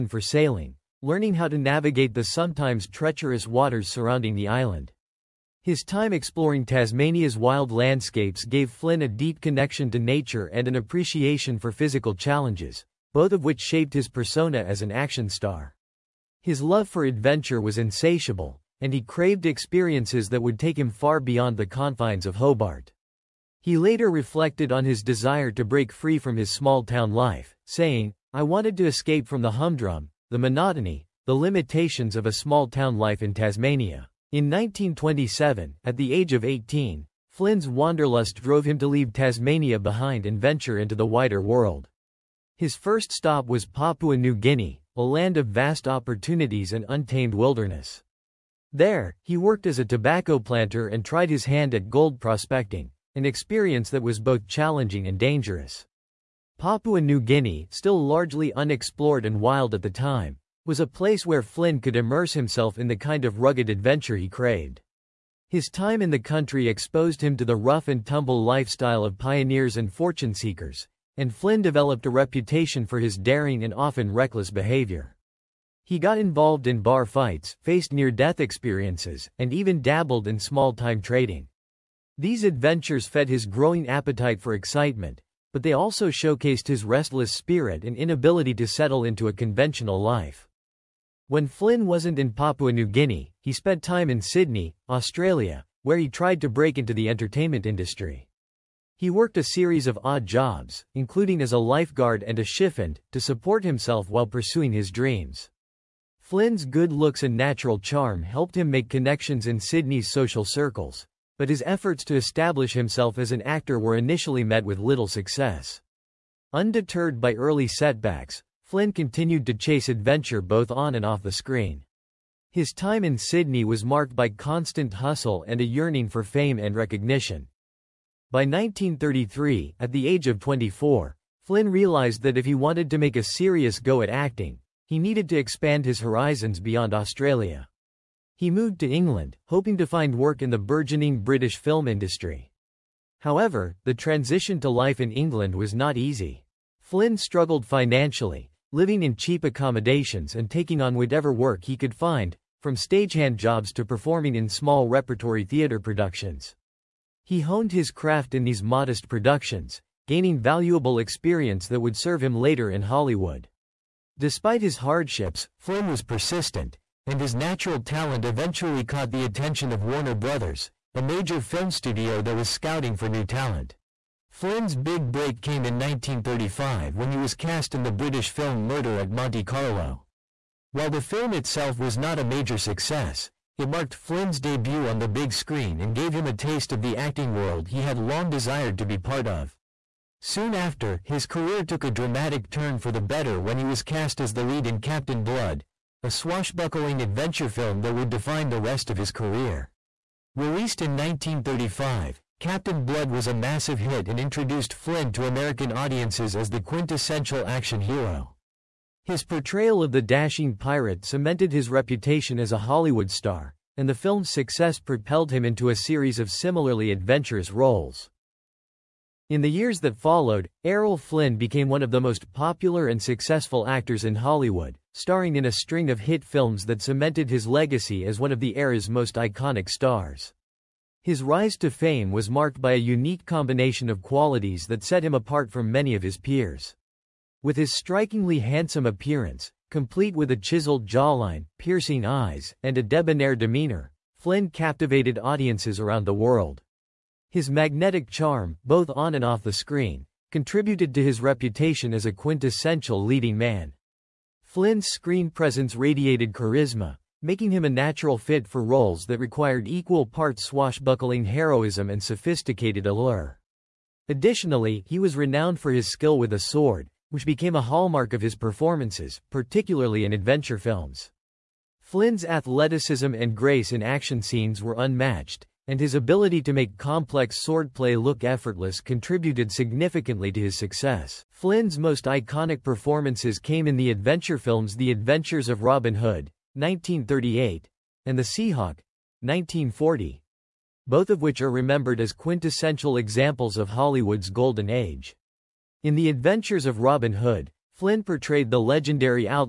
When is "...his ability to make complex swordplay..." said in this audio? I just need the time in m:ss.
4:35.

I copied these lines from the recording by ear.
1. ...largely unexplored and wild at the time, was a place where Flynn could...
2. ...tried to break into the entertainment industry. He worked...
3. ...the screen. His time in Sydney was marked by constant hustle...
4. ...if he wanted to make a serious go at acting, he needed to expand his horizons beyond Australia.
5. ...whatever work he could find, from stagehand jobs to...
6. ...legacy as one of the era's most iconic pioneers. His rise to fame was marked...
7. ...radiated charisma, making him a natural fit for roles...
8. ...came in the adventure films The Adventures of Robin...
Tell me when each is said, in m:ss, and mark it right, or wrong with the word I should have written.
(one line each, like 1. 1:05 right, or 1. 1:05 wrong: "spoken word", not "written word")
1. 0:58 right
2. 1:36 right
3. 2:01 right
4. 2:12 right
5. 2:30 right
6. 3:47 wrong: "stars", not "pioneers"
7. 4:15 right
8. 4:43 right.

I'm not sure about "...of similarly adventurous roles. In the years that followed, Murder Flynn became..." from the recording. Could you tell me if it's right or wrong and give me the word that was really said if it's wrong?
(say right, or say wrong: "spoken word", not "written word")
wrong: "Errol", not "Murder".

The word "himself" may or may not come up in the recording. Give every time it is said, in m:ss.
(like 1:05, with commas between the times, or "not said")
1:02, 1:43, 1:52.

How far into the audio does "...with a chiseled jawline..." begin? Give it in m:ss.
4:00.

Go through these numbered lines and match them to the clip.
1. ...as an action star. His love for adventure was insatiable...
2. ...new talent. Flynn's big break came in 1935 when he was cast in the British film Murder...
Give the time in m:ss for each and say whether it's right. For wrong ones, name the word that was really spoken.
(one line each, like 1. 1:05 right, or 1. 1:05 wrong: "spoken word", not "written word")
1. 0:14 right
2. 2:53 right.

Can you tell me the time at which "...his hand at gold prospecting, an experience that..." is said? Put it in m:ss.
0:51.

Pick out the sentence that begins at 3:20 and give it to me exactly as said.
Released in 1935, Captain Blood was a massive hit and introduced Flynn to American audiences as the quintessential action hero.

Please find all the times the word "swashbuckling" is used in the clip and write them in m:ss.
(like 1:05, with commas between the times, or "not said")
3:16, 4:20.